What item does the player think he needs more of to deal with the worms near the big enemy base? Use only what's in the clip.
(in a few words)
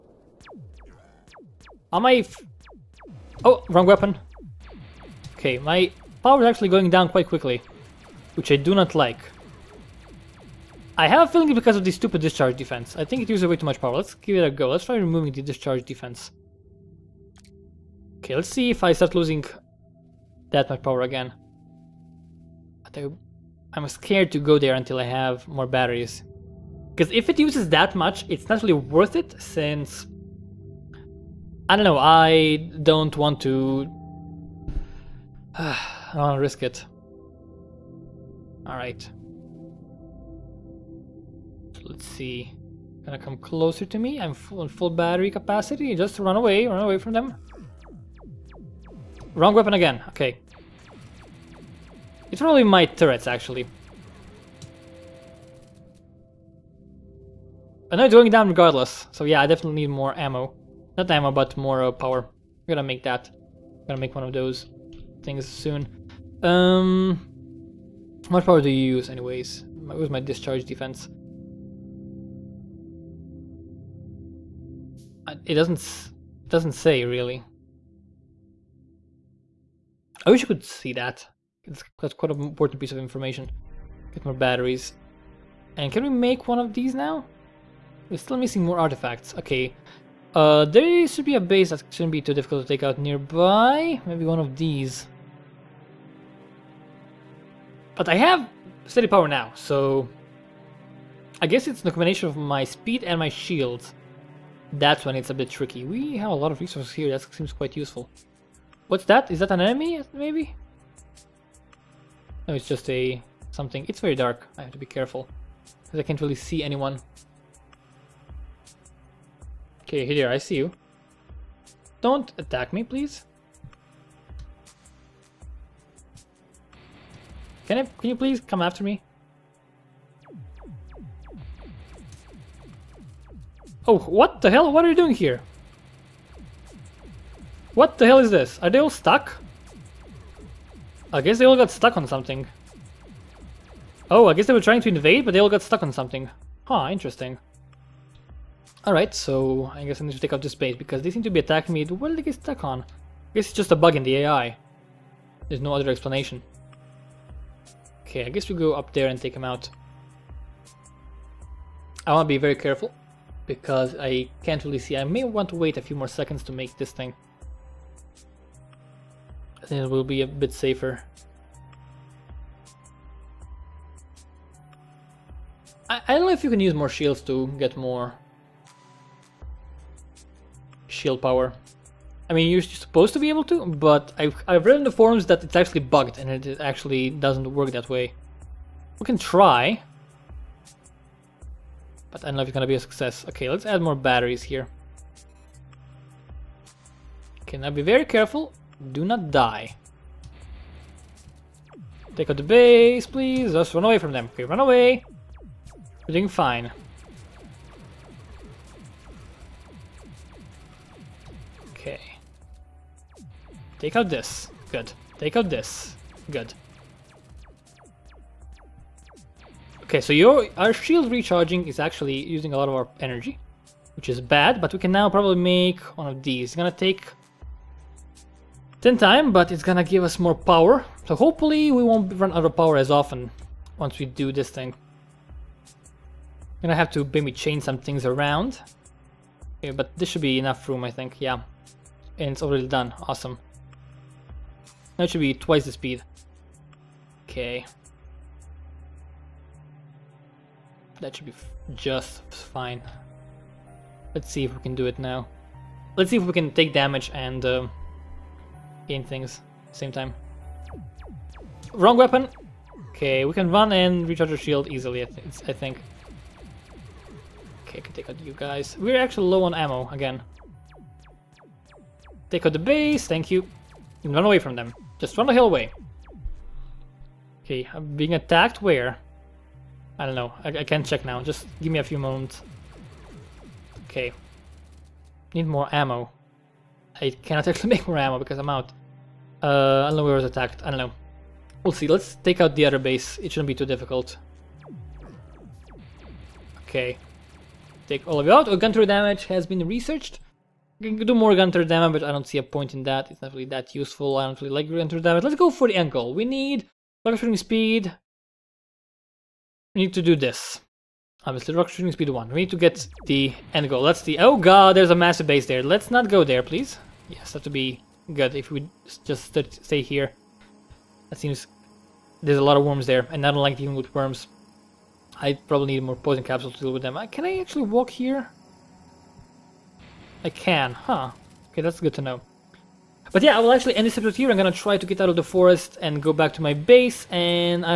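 Poison capsules.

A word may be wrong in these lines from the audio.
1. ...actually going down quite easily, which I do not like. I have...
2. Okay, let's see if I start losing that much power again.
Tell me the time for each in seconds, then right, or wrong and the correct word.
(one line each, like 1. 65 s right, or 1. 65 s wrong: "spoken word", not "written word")
1. 6 s wrong: "quickly", not "easily"
2. 18 s right.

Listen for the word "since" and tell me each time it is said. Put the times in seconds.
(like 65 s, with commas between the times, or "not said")
29 s.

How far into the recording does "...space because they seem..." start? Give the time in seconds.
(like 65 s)
150 s.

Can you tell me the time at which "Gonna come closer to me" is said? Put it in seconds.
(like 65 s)
43 s.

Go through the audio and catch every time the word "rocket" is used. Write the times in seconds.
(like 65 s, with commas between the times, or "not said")
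307 s, 311 s.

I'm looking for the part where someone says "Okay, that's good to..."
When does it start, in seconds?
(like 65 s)
331 s.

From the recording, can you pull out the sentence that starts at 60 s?
Not ammo, but more uh, power.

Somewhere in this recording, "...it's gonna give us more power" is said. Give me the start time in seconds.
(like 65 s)
229 s.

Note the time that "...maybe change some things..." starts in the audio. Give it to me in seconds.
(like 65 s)
237 s.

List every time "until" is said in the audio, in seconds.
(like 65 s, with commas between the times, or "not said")
24 s.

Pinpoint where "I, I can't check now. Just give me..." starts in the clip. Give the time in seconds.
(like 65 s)
280 s.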